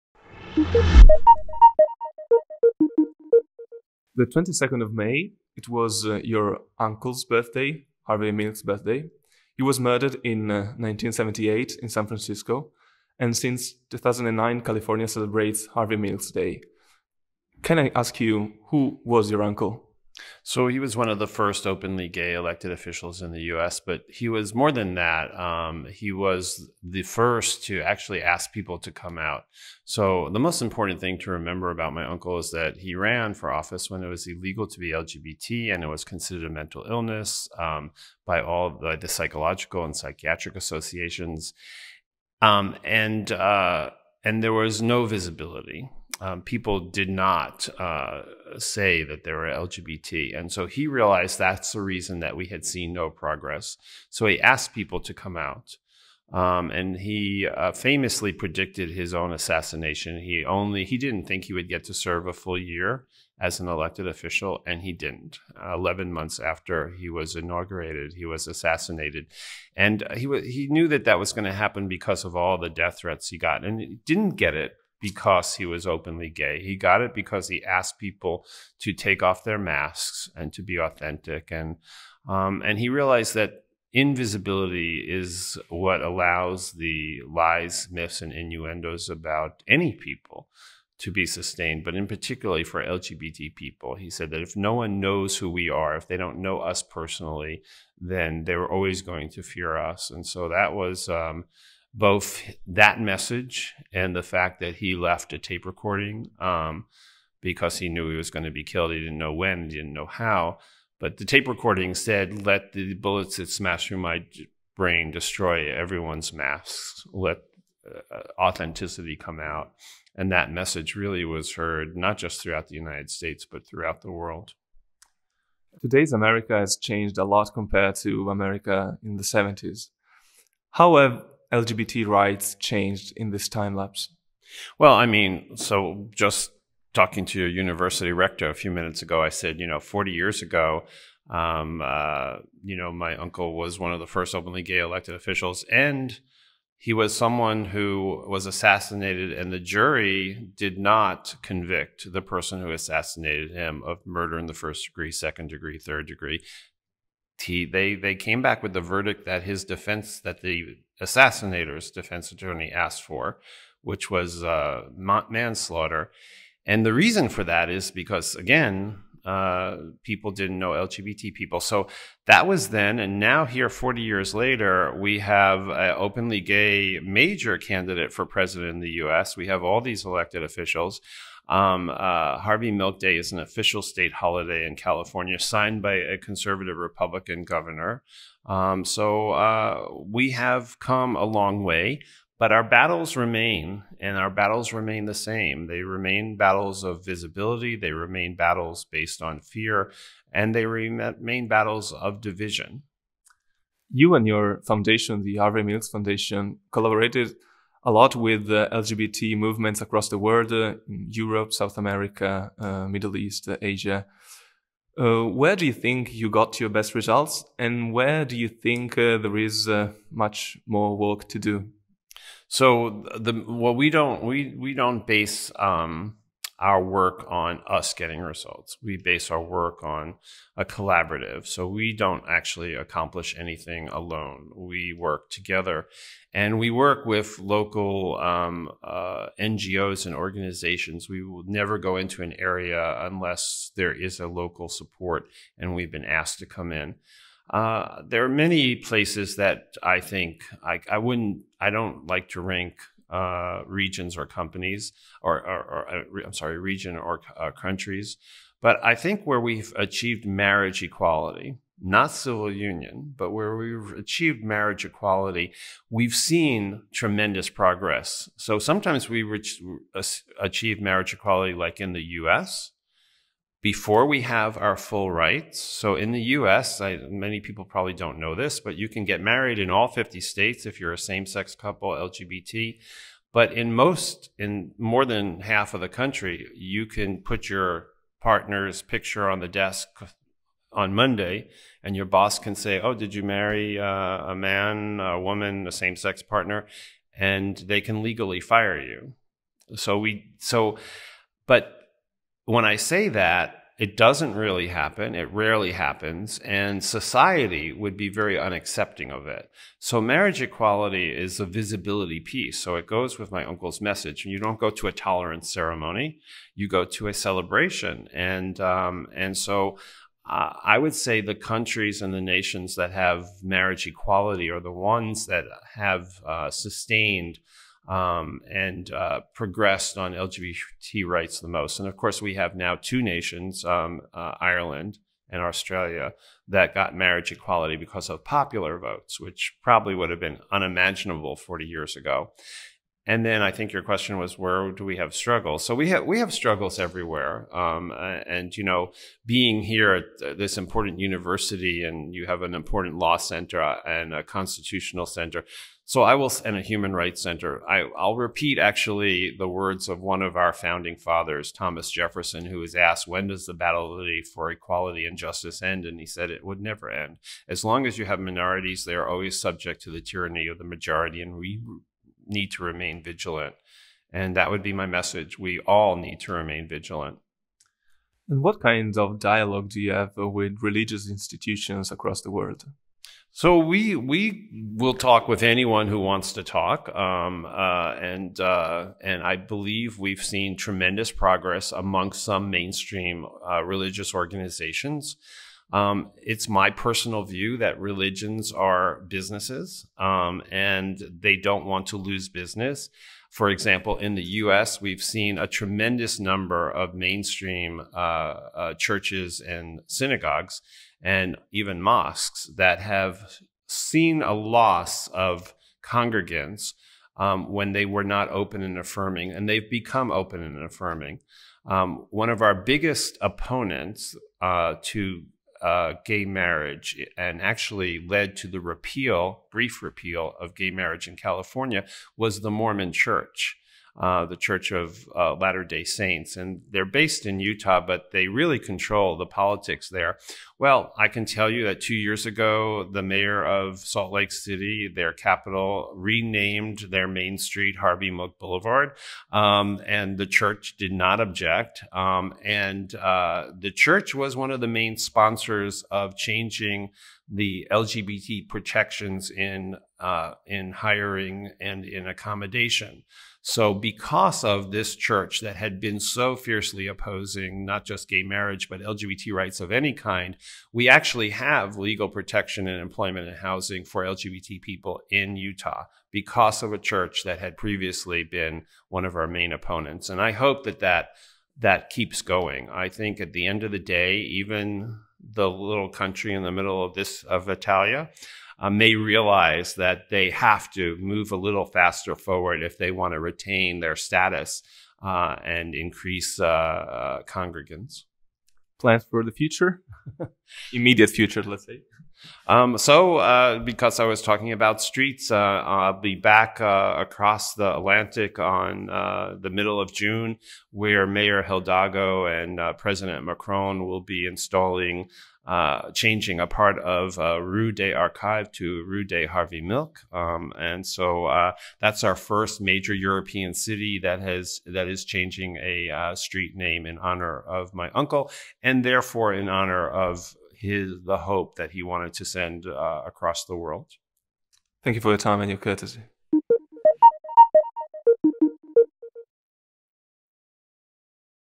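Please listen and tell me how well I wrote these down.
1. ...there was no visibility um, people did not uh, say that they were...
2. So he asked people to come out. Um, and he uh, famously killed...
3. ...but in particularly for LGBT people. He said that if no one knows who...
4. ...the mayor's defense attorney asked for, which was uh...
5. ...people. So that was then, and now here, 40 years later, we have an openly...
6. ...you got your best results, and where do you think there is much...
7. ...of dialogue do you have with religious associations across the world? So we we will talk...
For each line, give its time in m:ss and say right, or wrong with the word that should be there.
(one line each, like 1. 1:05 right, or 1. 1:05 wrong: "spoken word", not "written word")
1. 0:44 right
2. 0:54 wrong: "predicted", not "killed"
3. 1:31 right
4. 2:40 wrong: "assassinator", not "mayor"
5. 2:51 right
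6. 3:36 right
7. 6:18 wrong: "institutions", not "associations".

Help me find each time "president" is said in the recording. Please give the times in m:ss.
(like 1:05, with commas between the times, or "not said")
2:58, 8:32.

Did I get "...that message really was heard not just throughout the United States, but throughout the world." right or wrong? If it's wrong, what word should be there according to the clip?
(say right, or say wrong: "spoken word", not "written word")
right.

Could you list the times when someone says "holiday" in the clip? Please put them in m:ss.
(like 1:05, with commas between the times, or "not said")
3:04.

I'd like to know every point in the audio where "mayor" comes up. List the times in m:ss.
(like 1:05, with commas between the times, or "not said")
7:23, 8:31.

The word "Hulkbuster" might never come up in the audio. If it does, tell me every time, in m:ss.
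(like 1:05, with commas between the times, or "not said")
not said.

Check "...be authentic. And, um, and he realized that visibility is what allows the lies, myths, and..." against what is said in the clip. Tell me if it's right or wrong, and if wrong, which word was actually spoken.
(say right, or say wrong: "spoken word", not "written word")
wrong: "invisibility", not "visibility".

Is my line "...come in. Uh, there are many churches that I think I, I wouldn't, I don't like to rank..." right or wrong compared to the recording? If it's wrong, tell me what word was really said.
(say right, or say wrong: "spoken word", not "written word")
wrong: "places", not "churches".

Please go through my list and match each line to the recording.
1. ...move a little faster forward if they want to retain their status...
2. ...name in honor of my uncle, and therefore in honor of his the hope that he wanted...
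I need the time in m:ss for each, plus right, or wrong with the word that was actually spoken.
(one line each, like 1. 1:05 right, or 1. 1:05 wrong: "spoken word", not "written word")
1. 8:10 right
2. 8:46 right.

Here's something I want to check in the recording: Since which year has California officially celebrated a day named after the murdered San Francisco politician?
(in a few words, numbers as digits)
2009.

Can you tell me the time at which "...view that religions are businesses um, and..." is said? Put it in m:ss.
6:37.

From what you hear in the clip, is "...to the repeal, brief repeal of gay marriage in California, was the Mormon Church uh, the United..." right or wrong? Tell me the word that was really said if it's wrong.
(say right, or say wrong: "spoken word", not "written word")
wrong: "Church", not "United".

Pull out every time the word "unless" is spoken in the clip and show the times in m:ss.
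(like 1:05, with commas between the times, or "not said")
4:03.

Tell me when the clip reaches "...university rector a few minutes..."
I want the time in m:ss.
2:17.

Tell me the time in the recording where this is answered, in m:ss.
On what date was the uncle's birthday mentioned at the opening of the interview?
0:04.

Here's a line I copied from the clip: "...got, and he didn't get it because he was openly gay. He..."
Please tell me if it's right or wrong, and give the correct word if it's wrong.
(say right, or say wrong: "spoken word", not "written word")
right.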